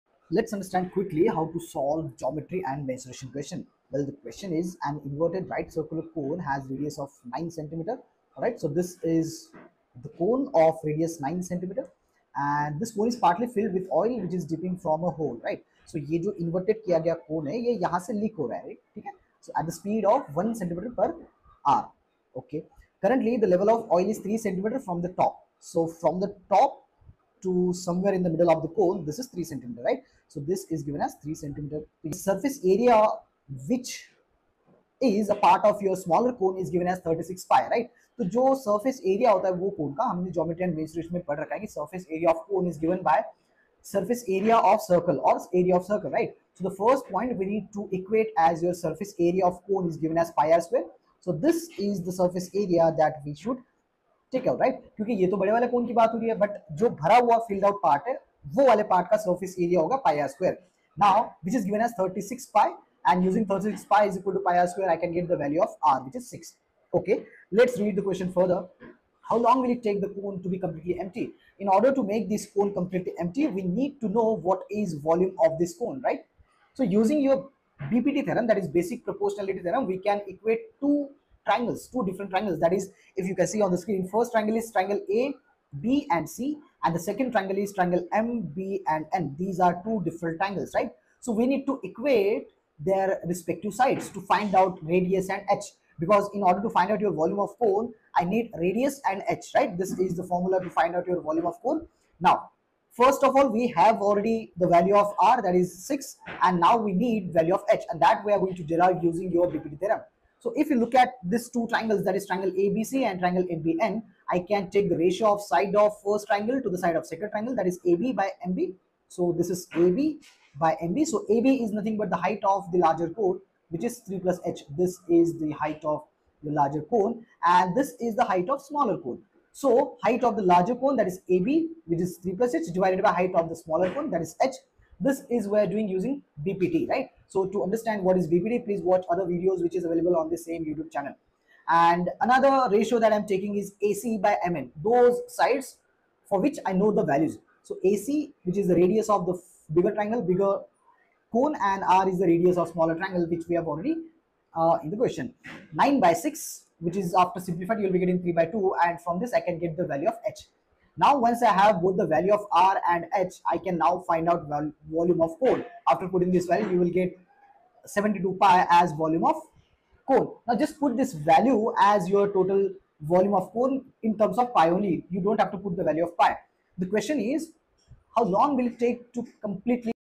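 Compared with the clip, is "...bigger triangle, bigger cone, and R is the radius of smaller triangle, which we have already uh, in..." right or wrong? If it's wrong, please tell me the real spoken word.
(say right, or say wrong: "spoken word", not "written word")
right.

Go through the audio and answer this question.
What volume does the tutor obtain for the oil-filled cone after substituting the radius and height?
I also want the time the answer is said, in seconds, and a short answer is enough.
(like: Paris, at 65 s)
72 pi, at 167 s.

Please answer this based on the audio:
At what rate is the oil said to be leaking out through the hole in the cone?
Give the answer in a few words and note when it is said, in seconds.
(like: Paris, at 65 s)
1 cm per hour, at 20 s.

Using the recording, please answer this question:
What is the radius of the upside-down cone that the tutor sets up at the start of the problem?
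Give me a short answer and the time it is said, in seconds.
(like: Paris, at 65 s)
9 centimeters, at 6 s.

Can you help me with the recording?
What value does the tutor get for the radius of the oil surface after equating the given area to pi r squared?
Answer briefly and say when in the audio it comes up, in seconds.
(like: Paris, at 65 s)
6, at 66 s.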